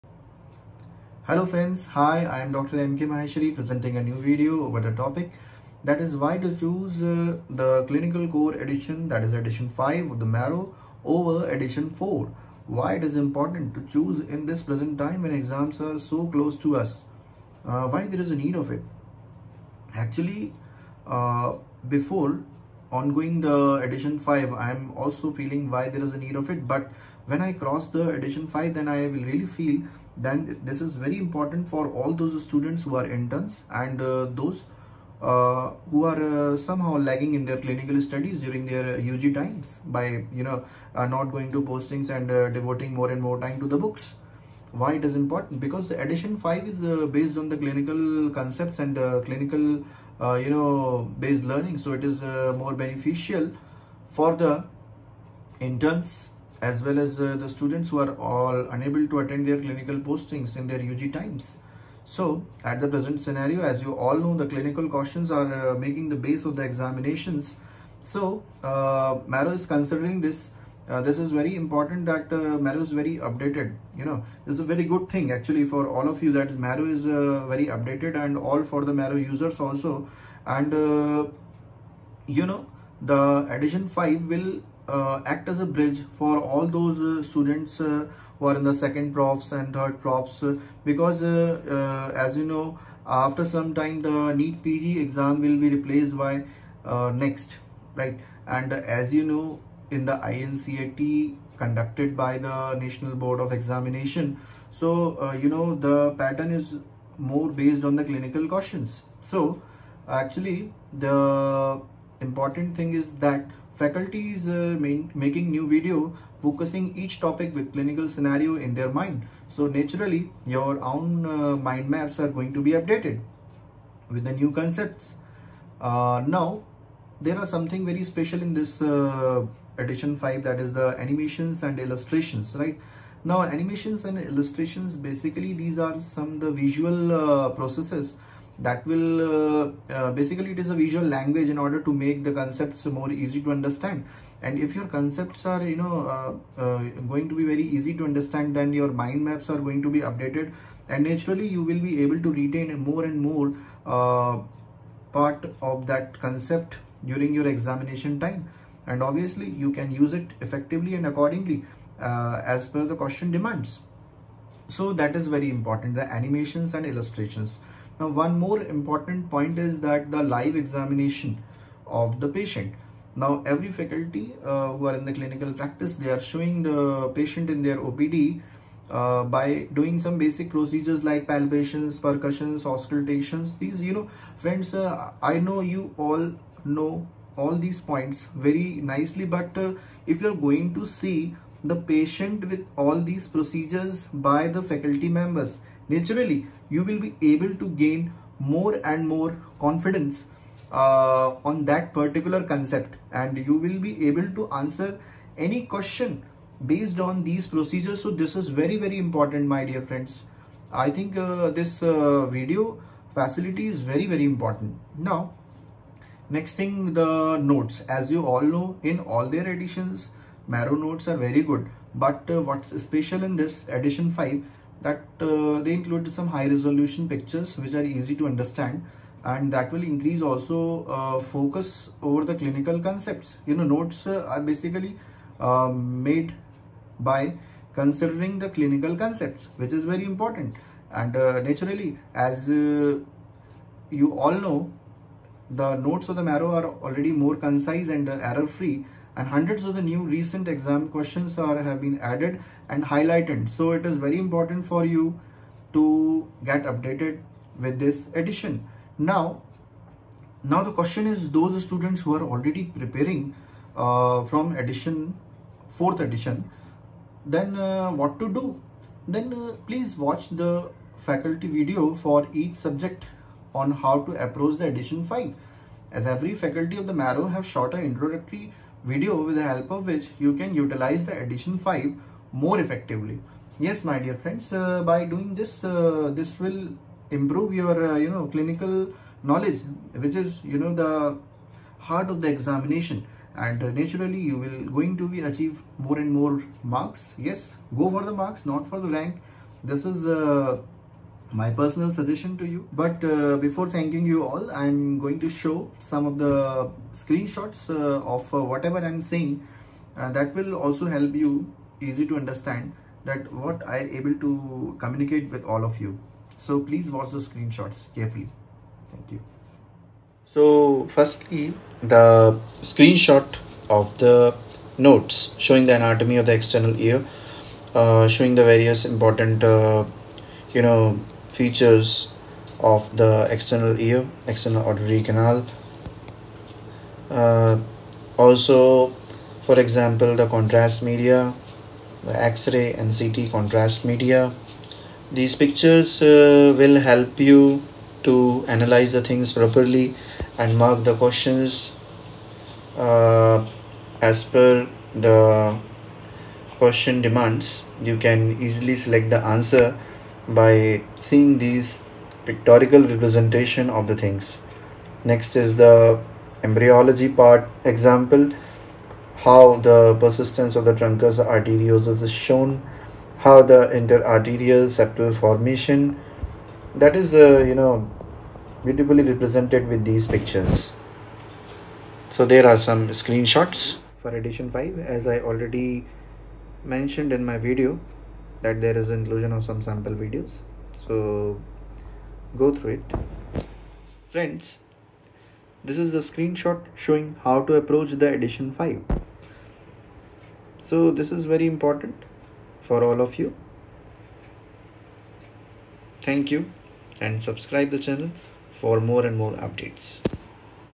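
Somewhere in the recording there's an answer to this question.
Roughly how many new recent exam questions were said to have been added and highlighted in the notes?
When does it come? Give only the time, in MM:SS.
04:09.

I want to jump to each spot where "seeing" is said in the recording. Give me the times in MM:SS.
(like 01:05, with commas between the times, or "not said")
06:00.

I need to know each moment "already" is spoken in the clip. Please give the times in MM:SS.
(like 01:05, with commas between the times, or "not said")
04:06, 04:22, 06:25.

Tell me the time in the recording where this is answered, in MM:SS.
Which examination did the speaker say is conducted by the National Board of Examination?
01:40.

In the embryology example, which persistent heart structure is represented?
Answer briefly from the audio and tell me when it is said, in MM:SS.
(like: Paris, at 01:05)
truncus arteriosus, at 06:10.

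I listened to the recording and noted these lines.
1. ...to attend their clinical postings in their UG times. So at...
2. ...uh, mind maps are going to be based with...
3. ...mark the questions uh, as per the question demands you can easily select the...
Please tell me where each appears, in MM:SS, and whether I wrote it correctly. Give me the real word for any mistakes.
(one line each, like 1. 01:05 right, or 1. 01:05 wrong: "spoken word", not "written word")
1. 00:59 right
2. 02:01 wrong: "updated", not "based"
3. 05:50 right.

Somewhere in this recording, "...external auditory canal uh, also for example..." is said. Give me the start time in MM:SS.
05:34.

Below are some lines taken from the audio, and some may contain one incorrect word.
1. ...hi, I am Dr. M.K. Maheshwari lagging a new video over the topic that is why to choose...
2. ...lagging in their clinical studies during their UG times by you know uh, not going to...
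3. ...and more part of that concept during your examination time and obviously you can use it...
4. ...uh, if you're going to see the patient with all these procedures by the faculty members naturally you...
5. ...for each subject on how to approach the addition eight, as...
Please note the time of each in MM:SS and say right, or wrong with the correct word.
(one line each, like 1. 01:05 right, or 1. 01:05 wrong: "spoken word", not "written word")
1. 00:01 wrong: "presenting", not "lagging"
2. 00:36 right
3. 02:33 right
4. 03:09 right
5. 04:31 wrong: "five", not "eight".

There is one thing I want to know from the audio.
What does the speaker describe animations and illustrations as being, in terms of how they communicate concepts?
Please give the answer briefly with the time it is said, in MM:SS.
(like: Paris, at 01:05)
a visual language, at 02:16.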